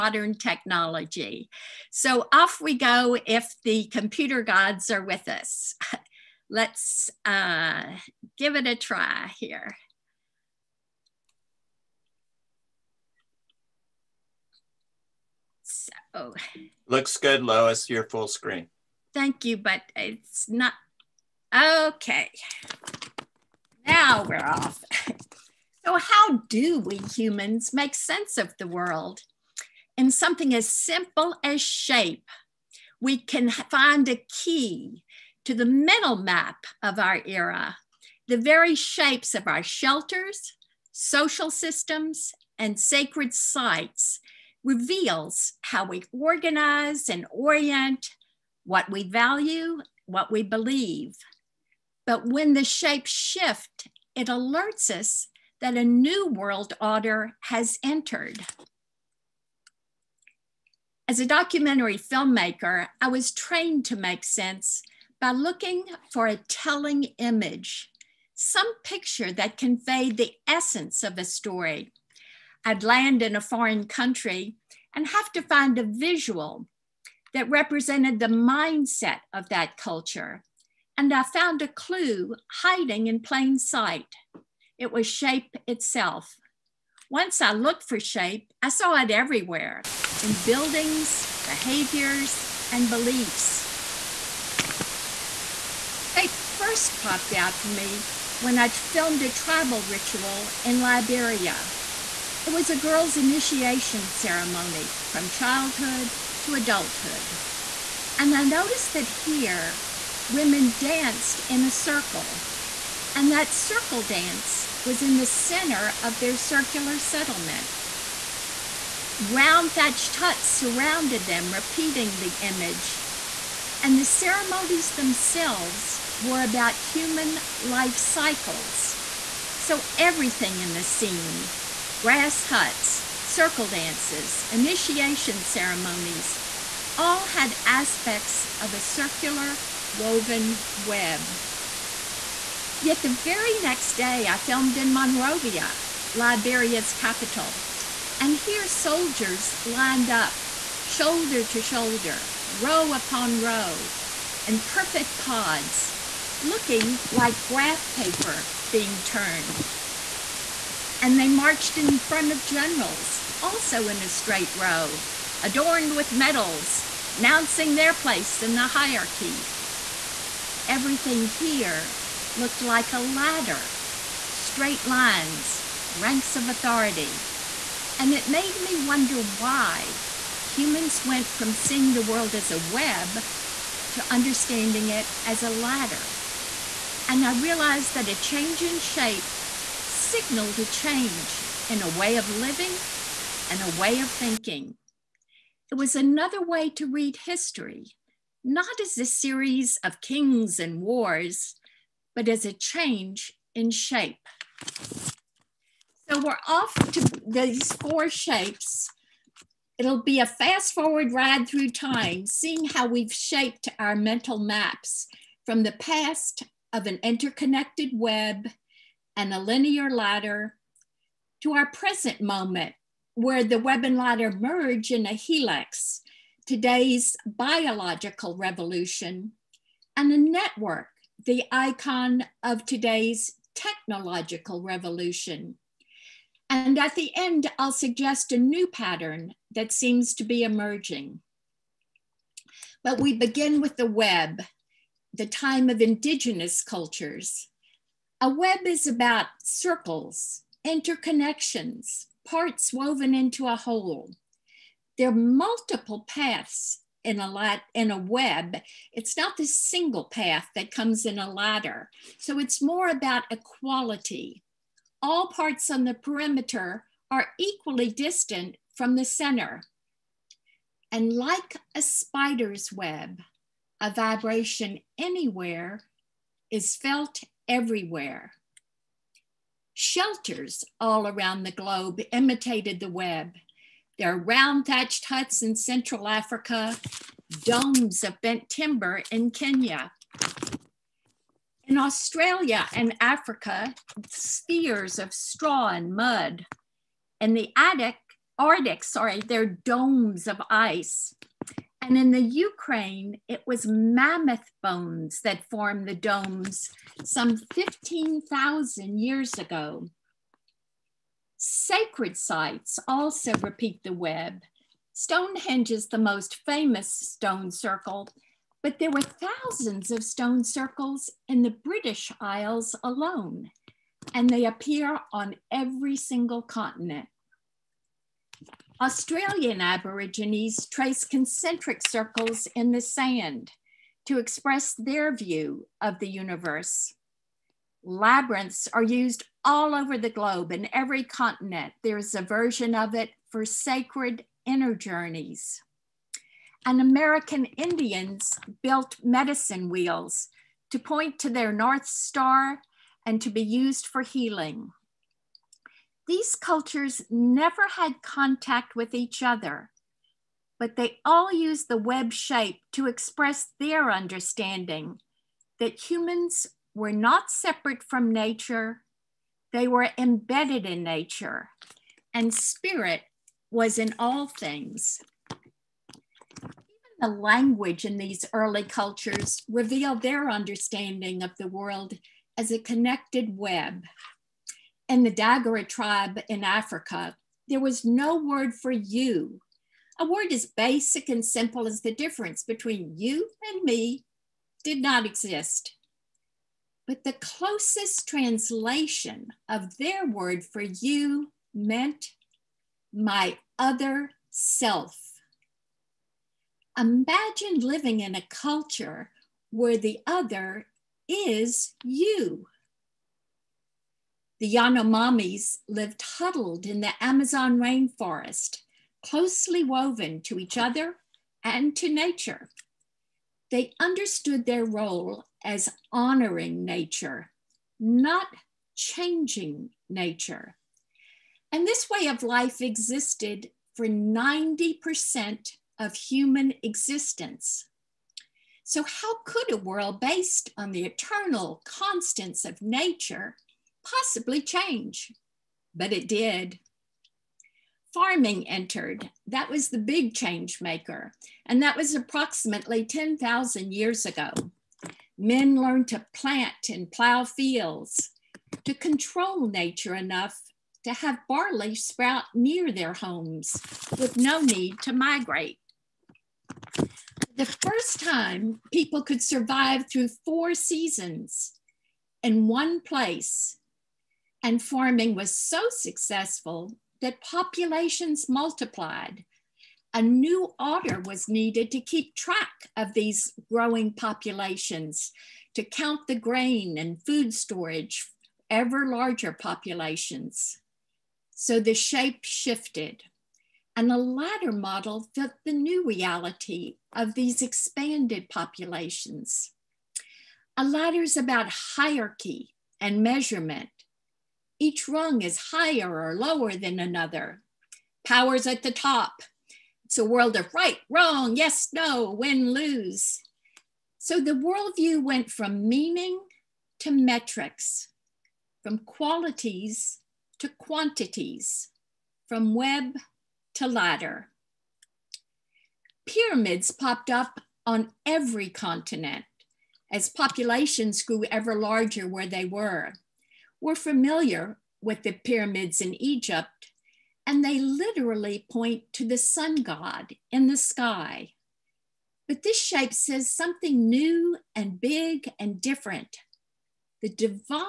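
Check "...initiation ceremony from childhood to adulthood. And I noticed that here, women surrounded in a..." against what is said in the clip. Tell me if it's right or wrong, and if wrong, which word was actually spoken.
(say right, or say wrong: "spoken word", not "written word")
wrong: "danced", not "surrounded".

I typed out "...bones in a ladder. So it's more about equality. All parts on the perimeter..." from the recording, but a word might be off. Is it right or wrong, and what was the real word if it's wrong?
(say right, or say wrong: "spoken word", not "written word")
wrong: "comes", not "bones".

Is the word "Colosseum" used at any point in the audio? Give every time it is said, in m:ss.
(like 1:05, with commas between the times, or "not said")
not said.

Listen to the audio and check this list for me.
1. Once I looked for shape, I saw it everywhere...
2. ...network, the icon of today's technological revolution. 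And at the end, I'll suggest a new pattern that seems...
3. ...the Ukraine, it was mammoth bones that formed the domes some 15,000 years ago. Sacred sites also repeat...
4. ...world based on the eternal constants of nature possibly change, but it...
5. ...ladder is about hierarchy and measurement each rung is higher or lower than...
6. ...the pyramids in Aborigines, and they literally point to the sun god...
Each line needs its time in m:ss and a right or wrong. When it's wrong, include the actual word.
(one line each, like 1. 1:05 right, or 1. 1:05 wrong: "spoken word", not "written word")
1. 1:27 right
2. 3:50 right
3. 5:02 right
4. 7:19 right
5. 8:20 right
6. 8:55 wrong: "Egypt", not "Aborigines".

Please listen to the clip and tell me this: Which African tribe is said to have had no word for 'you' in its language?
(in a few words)
Dagara.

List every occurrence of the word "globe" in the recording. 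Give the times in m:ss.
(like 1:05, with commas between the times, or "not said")
4:41, 5:40.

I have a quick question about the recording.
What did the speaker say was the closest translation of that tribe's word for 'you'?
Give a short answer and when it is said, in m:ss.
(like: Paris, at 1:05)
My other self, at 6:42.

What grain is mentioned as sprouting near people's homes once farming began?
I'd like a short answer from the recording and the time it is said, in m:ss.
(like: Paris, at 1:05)
Barley, at 7:41.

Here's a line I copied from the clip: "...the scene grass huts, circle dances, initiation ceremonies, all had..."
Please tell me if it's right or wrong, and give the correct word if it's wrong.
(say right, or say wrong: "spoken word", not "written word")
right.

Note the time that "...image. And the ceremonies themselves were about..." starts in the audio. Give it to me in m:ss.
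2:02.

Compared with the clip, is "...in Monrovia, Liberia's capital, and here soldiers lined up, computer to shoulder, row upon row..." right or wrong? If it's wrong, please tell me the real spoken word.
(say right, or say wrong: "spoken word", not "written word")
wrong: "shoulder", not "computer".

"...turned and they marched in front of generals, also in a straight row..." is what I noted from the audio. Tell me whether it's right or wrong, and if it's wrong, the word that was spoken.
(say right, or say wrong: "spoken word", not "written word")
right.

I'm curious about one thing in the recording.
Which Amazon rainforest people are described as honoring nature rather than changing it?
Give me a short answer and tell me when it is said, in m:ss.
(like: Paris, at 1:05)
Yanomamis, at 6:54.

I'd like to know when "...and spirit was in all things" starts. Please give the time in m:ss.
6:12.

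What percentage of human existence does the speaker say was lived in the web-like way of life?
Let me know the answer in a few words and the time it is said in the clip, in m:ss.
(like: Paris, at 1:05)
90%, at 7:13.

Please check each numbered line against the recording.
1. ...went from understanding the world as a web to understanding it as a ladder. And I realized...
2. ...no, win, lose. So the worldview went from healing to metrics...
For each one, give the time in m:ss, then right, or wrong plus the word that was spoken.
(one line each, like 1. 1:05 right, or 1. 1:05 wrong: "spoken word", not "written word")
1. 3:01 wrong: "seeing", not "understanding"
2. 8:31 wrong: "meaning", not "healing".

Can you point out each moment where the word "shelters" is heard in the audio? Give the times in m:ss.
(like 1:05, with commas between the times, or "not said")
0:39, 4:39.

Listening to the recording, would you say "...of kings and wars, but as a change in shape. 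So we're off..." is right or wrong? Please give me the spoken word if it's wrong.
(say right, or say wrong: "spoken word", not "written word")
right.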